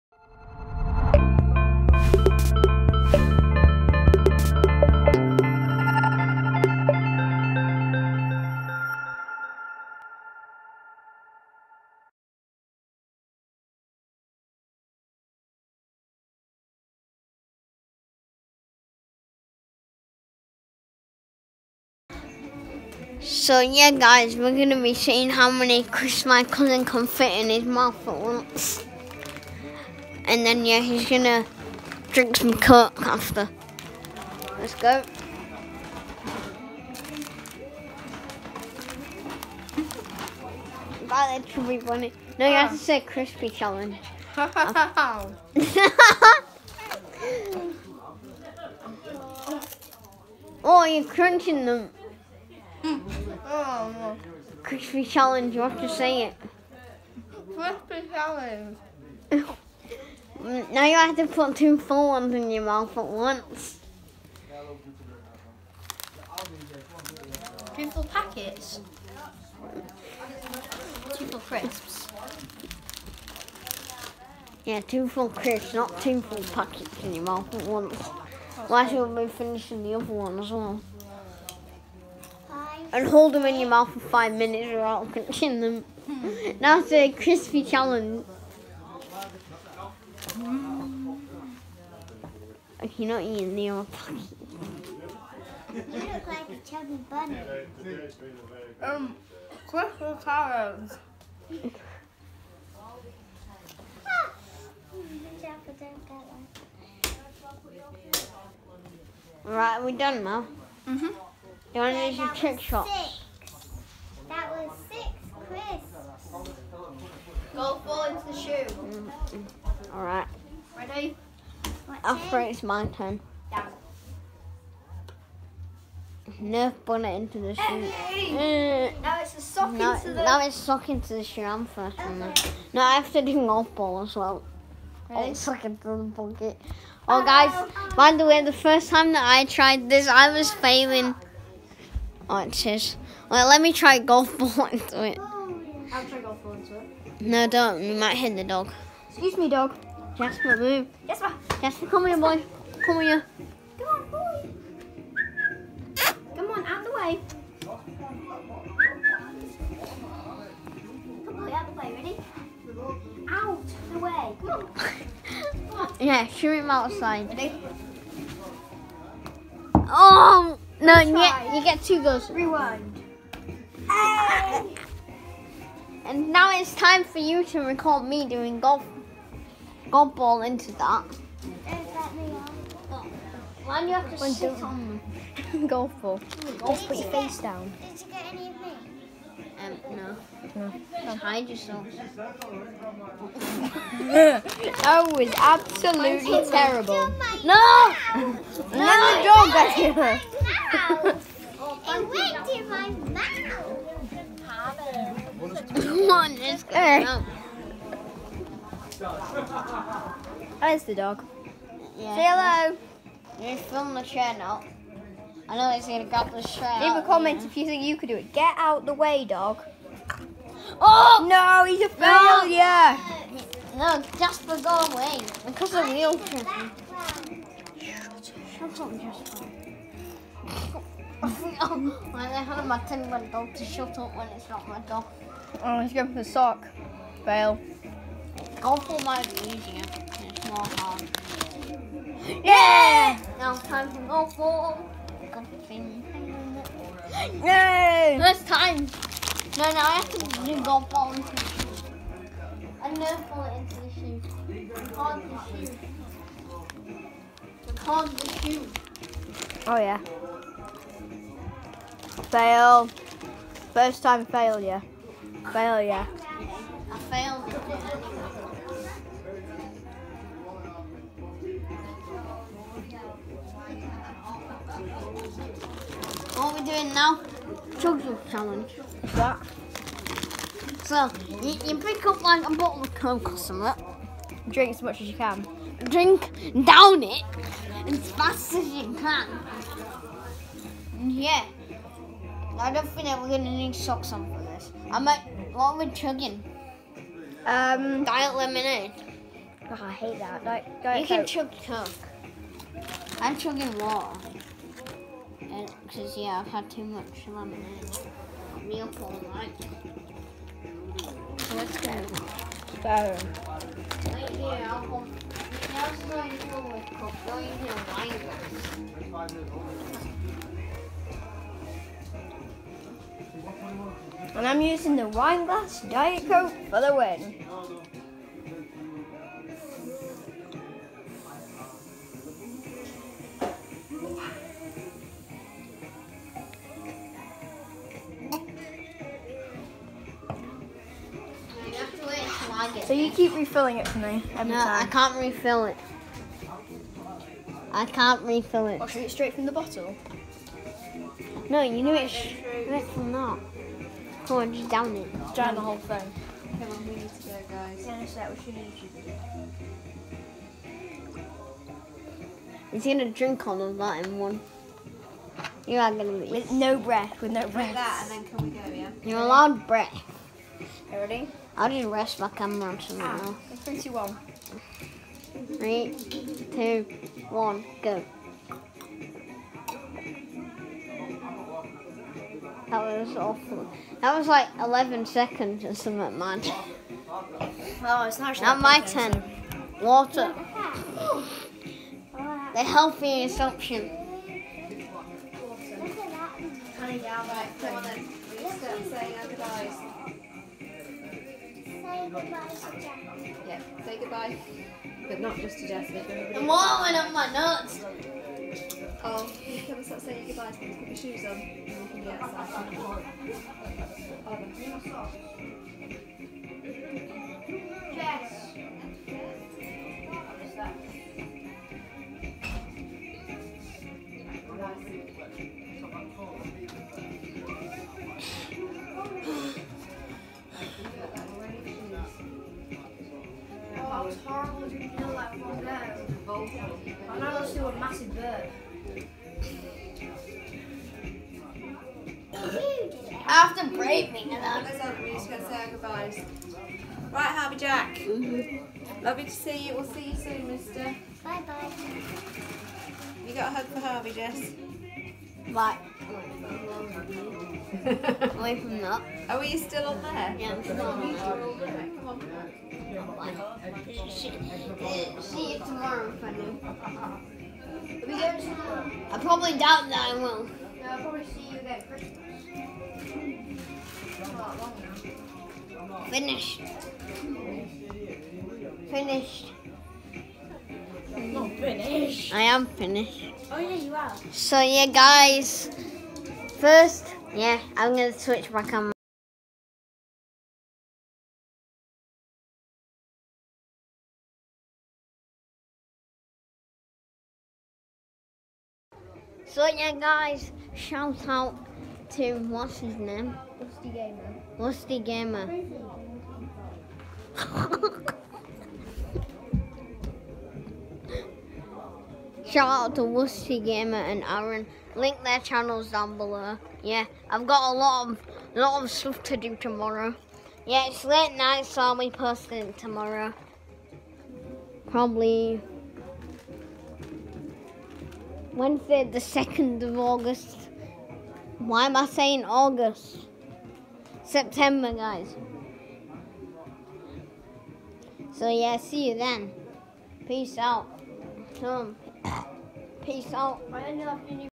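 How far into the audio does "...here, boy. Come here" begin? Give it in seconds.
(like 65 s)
152 s.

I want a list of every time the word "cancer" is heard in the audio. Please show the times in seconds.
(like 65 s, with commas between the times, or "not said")
not said.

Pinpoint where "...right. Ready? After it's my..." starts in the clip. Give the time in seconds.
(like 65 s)
120 s.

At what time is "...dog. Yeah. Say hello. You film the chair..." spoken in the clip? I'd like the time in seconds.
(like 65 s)
210 s.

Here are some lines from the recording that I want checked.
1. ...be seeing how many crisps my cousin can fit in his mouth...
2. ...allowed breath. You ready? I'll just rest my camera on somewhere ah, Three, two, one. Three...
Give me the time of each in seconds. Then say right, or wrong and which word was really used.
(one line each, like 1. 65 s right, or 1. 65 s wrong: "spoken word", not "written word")
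1. 24 s right
2. 369 s right.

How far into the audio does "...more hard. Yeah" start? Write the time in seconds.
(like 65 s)
240 s.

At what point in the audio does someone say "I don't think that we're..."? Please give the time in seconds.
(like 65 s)
292 s.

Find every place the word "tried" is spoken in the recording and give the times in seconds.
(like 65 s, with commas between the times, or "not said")
139 s.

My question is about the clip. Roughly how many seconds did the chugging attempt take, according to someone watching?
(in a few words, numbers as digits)
11.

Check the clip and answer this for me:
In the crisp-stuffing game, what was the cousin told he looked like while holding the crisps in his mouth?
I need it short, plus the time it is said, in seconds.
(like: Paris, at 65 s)
A chubby bunny, at 96 s.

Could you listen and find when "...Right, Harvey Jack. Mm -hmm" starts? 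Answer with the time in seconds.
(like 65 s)
447 s.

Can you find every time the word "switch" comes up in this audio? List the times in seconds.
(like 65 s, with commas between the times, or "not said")
488 s.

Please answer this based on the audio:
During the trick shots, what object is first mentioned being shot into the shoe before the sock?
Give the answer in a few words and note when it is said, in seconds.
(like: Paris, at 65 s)
Nerf bullet, at 126 s.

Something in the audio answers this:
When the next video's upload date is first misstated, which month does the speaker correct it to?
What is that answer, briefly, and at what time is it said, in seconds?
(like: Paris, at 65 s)
September, at 534 s.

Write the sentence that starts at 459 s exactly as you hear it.
Oh, are we still on there?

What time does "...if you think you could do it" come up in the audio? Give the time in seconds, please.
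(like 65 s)
217 s.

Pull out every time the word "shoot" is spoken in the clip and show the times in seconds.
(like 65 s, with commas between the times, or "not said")
166 s.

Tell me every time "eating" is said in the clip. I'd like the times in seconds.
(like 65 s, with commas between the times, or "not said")
93 s.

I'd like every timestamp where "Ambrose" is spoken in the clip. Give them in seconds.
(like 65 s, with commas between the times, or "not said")
not said.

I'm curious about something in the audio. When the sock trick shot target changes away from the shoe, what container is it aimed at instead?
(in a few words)
Bucket.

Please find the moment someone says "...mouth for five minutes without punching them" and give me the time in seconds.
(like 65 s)
83 s.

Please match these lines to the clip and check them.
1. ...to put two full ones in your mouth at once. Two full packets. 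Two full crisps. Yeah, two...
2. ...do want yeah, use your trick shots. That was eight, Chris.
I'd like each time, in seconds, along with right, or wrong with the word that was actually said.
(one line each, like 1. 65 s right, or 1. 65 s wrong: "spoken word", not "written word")
1. 61 s right
2. 111 s wrong: "six", not "eight".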